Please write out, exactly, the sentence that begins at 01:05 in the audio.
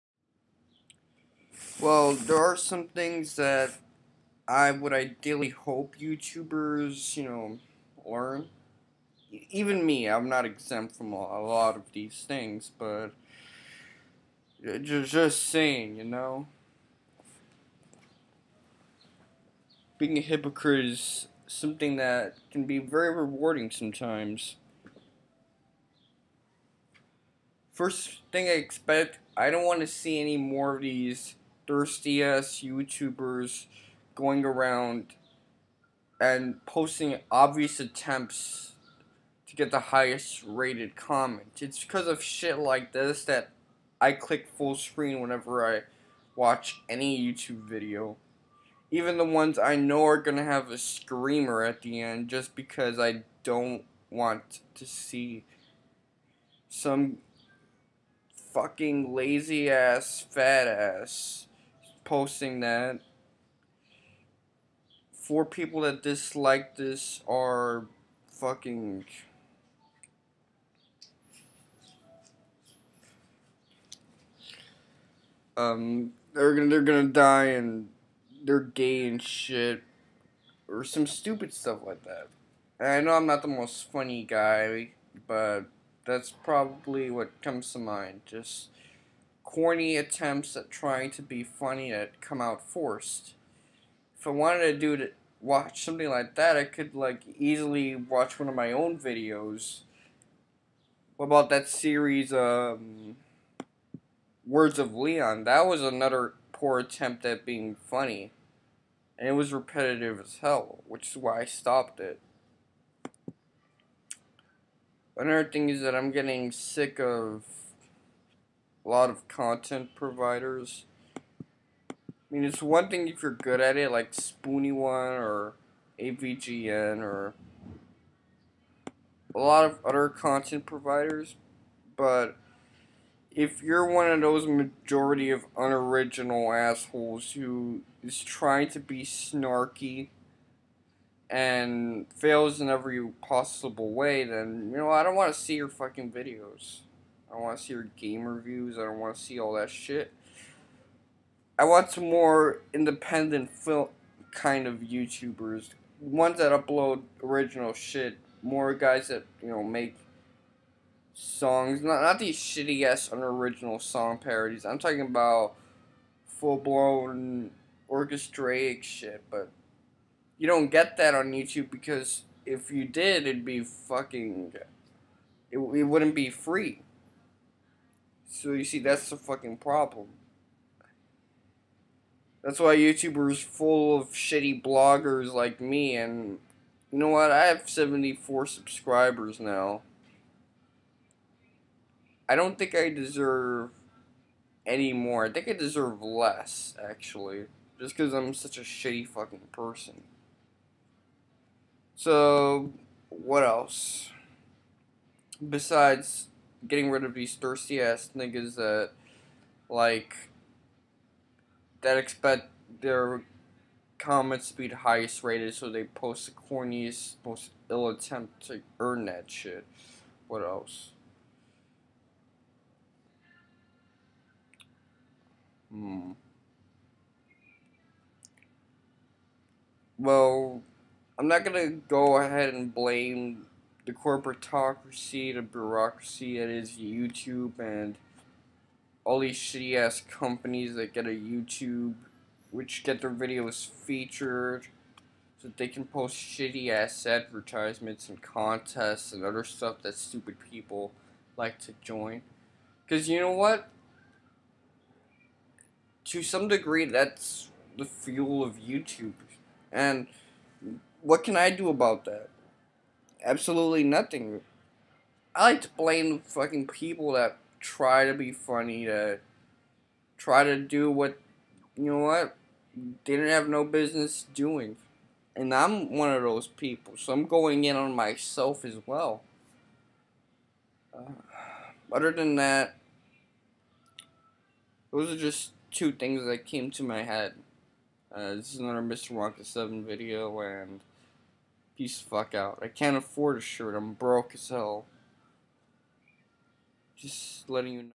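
Four people that dislike this are fucking.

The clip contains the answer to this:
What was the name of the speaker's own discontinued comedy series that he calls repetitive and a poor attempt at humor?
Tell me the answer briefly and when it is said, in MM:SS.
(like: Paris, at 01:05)
Words of Leon, at 01:44.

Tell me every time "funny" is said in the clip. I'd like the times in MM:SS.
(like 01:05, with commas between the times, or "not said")
01:23, 01:31, 01:47, 04:28.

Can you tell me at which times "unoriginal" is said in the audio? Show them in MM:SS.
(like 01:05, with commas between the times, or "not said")
02:15, 02:43.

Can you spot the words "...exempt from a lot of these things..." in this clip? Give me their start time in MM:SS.
00:10.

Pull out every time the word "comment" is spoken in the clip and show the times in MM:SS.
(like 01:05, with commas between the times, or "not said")
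00:40, 03:33.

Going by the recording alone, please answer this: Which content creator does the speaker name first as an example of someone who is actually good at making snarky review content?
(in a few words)
Spoony One.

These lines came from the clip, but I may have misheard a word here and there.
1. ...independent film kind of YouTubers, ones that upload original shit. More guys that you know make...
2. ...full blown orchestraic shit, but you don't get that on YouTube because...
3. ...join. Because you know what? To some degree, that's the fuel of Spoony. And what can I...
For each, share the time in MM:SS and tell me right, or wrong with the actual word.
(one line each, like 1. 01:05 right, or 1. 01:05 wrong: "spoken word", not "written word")
1. 02:32 right
2. 02:46 right
3. 04:11 wrong: "YouTube", not "Spoony".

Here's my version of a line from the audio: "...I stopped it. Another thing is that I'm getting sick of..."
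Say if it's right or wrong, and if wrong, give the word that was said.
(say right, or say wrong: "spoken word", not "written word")
right.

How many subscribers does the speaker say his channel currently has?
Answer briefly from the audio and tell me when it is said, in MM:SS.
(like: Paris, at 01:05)
74, at 03:07.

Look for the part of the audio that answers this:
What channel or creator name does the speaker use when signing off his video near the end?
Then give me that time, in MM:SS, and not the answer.
04:48.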